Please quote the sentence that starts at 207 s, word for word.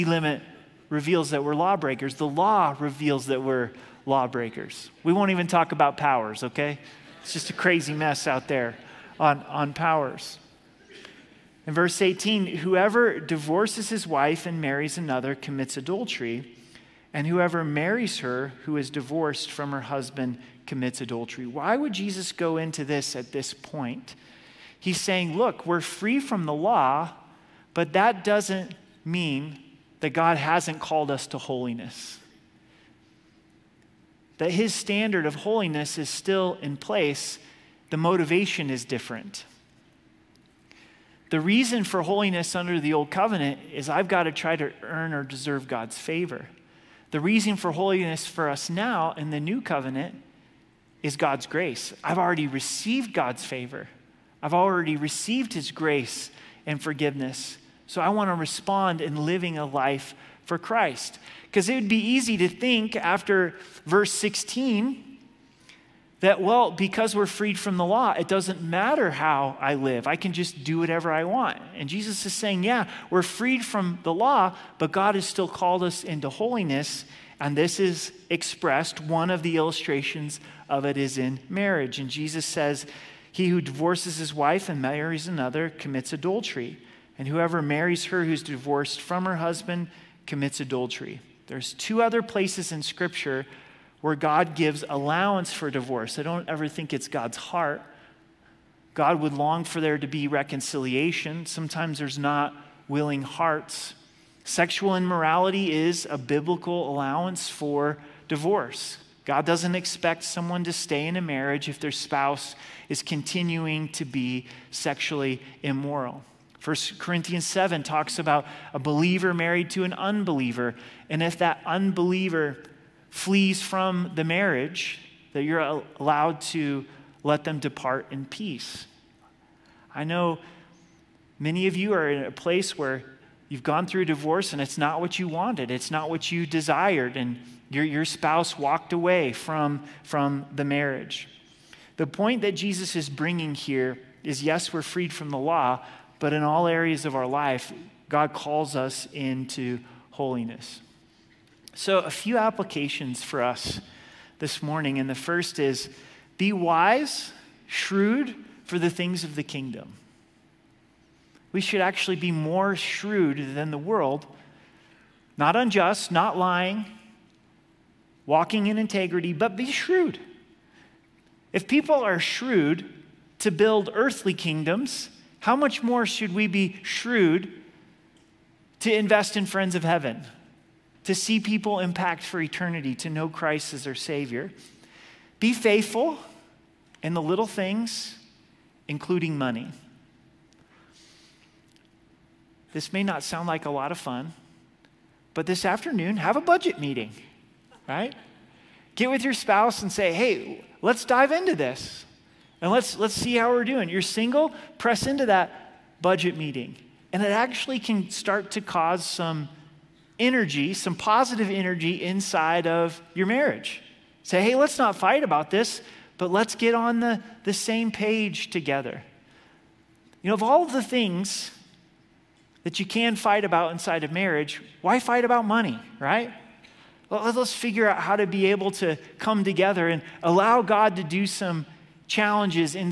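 And it actually can start to cause some energy, some positive energy inside of your marriage.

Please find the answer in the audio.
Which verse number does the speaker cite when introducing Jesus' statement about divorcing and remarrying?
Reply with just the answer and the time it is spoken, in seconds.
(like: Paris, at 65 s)
18, at 12 s.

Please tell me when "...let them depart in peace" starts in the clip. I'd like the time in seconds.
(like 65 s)
127 s.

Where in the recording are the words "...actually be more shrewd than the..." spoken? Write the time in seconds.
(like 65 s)
161 s.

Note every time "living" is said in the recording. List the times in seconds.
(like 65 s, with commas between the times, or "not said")
59 s.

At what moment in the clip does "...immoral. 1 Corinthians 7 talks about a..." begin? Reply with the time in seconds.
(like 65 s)
115 s.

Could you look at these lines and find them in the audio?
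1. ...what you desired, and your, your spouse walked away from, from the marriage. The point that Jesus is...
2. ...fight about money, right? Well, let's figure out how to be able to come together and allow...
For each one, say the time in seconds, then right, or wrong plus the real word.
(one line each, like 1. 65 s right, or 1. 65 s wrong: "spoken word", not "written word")
1. 136 s right
2. 224 s right.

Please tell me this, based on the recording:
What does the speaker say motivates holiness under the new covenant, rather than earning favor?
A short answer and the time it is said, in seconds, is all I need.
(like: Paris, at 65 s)
God's grace, at 51 s.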